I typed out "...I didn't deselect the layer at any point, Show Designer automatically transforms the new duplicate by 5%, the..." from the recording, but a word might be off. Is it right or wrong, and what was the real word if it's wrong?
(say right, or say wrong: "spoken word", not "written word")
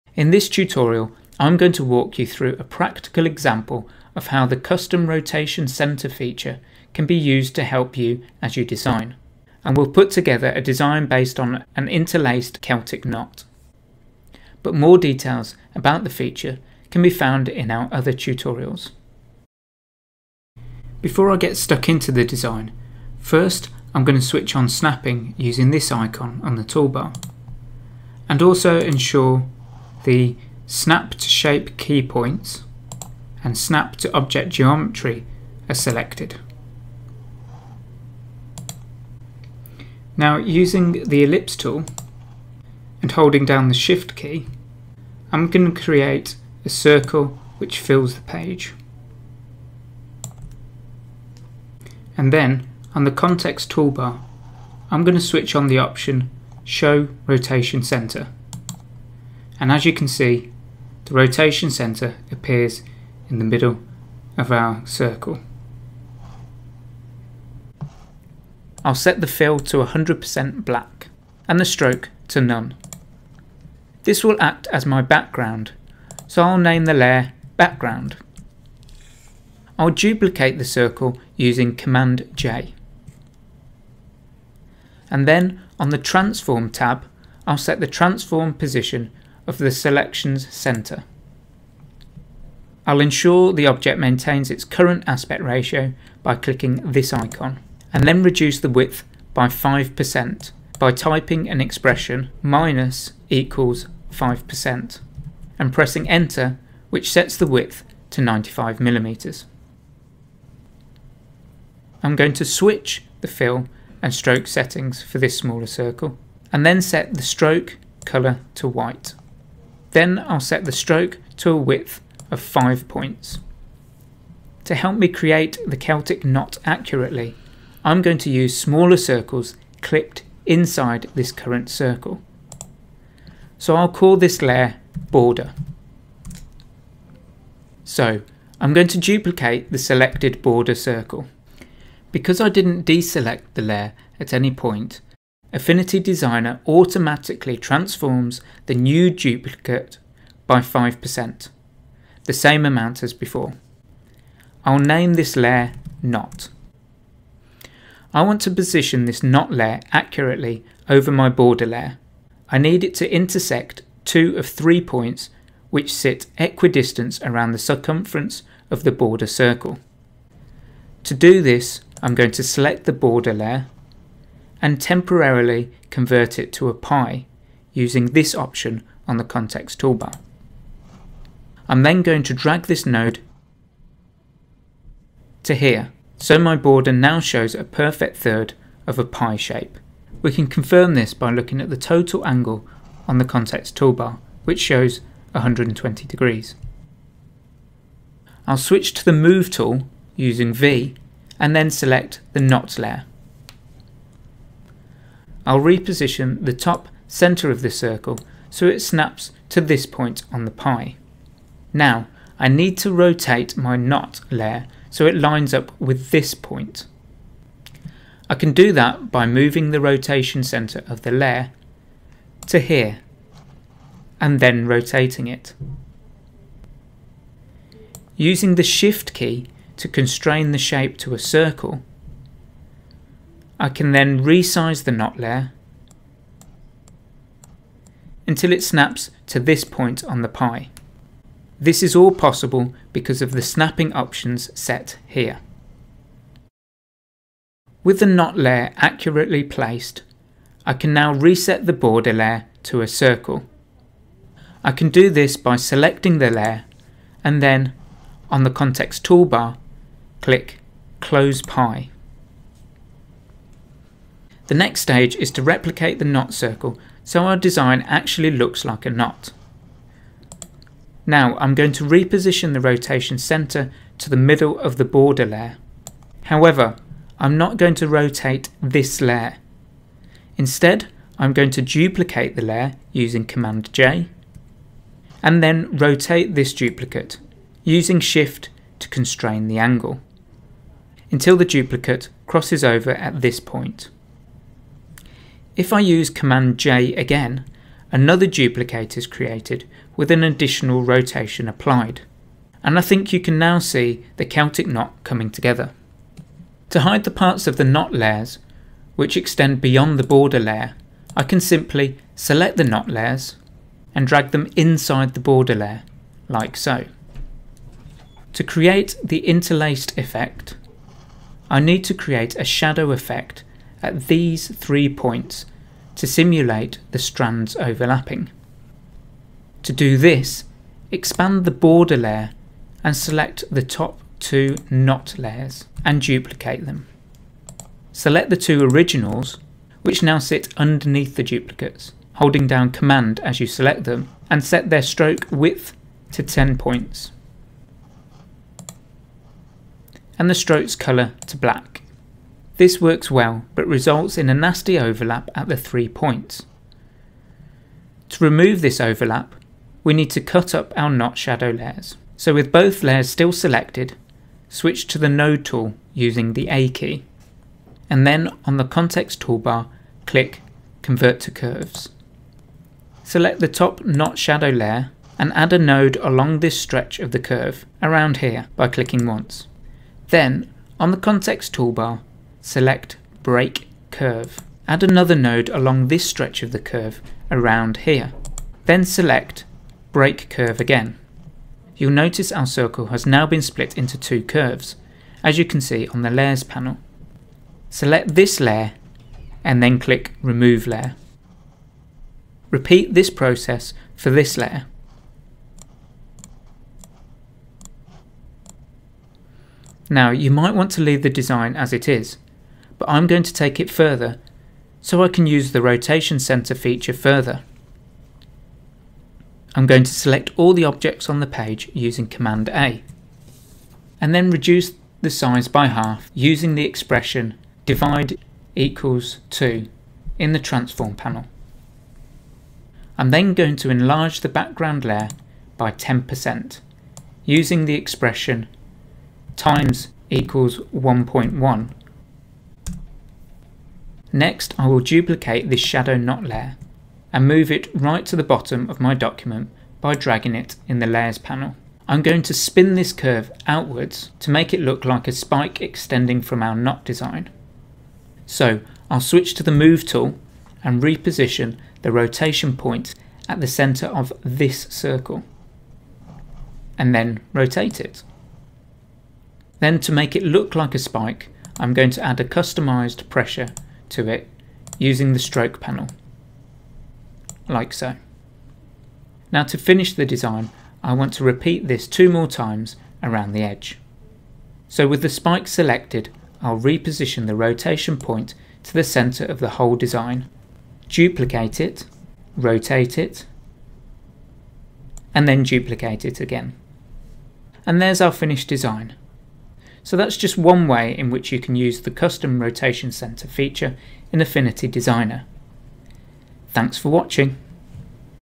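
wrong: "Affinity", not "Show".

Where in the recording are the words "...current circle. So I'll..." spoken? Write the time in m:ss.
2:11.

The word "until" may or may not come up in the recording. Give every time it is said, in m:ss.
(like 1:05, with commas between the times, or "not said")
3:58, 4:51.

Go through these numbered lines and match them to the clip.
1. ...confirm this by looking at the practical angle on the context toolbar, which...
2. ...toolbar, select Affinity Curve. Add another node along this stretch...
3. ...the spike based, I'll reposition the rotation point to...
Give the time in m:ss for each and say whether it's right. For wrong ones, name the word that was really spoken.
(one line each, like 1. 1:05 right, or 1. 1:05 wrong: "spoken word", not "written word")
1. 3:10 wrong: "total", not "practical"
2. 6:21 wrong: "Break", not "Affinity"
3. 8:05 wrong: "selected", not "based".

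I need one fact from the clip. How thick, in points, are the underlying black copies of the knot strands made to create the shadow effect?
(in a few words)
10 points.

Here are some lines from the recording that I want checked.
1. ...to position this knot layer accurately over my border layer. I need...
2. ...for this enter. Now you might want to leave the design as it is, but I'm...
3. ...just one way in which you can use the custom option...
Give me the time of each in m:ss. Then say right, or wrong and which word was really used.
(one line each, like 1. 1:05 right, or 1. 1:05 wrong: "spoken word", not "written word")
1. 2:38 right
2. 6:43 wrong: "layer", not "enter"
3. 8:20 wrong: "rotation", not "option".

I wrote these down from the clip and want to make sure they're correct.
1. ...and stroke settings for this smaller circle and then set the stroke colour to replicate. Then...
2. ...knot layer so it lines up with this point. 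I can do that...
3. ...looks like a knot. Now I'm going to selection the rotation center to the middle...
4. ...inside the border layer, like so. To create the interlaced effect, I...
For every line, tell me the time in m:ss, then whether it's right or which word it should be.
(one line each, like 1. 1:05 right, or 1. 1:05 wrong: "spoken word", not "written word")
1. 1:54 wrong: "white", not "replicate"
2. 3:33 right
3. 4:28 wrong: "reposition", not "selection"
4. 5:14 right.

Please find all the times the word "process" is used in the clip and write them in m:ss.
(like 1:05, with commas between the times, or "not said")
6:43.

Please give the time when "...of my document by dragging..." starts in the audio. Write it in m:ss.
7:28.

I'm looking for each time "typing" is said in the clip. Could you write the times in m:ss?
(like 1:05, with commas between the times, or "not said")
1:40.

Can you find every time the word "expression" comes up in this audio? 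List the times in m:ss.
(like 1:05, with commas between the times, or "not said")
1:41, 7:06, 7:17.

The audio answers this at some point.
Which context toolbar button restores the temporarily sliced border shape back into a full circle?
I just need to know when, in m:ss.
4:20.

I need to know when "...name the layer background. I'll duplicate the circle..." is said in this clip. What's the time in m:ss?
1:16.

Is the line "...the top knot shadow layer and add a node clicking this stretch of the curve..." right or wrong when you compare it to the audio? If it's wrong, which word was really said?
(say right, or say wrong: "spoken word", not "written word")
wrong: "along", not "clicking".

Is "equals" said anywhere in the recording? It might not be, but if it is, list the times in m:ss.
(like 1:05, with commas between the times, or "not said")
1:43, 7:08, 7:20.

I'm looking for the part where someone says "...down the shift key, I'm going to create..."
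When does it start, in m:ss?
0:43.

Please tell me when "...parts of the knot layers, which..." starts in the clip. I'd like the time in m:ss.
5:07.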